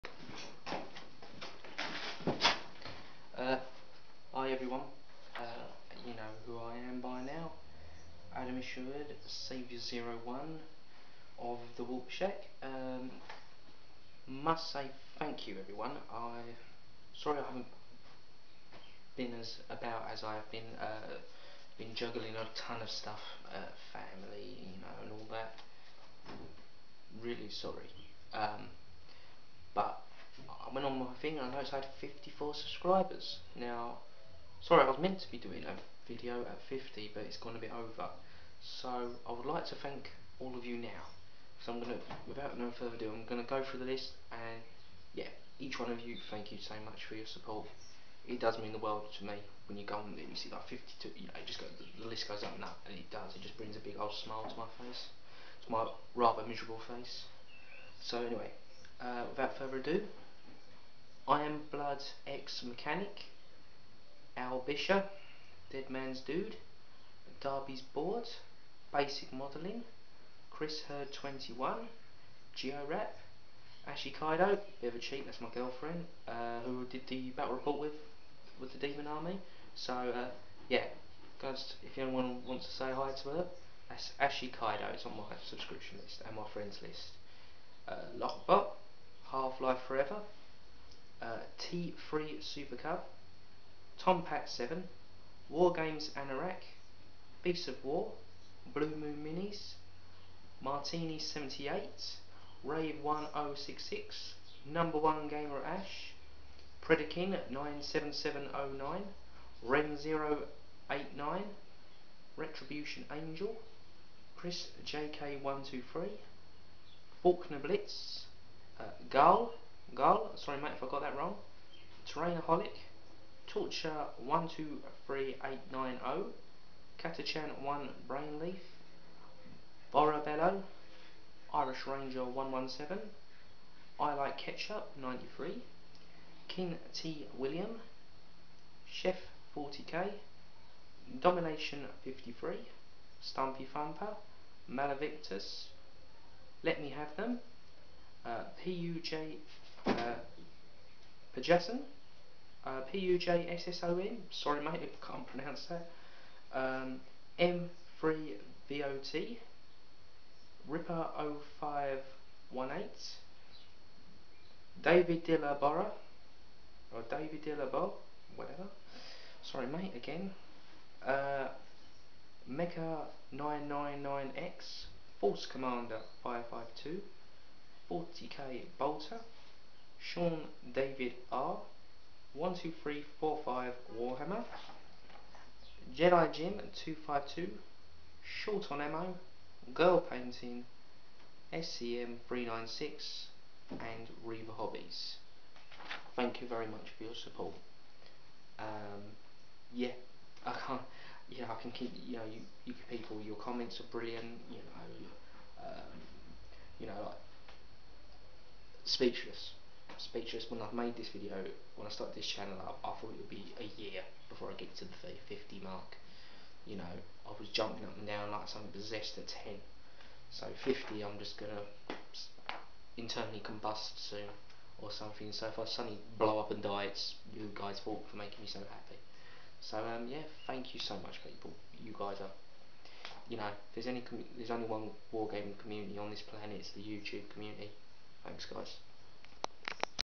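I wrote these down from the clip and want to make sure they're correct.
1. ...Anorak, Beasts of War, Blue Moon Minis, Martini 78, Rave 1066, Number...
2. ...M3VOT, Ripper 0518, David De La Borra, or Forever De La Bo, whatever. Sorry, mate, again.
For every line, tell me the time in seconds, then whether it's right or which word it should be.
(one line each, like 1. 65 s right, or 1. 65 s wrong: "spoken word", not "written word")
1. 96 s right
2. 157 s wrong: "David", not "Forever".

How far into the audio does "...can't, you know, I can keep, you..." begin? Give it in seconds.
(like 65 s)
200 s.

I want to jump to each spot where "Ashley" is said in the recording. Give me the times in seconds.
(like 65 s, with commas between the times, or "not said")
73 s, 84 s.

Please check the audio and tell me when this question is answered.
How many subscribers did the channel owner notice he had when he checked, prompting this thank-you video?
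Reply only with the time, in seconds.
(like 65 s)
31 s.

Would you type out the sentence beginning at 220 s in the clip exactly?
So 50, I'm just going to internally combust soon or something.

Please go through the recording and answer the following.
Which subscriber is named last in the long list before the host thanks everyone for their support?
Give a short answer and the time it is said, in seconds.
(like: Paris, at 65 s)
Reaver Hobbies, at 194 s.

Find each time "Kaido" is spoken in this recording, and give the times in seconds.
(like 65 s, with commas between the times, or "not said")
74 s, 84 s.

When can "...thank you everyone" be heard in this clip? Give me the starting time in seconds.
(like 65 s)
15 s.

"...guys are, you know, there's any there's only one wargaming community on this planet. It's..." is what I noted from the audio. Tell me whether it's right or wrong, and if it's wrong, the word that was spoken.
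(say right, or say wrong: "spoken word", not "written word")
right.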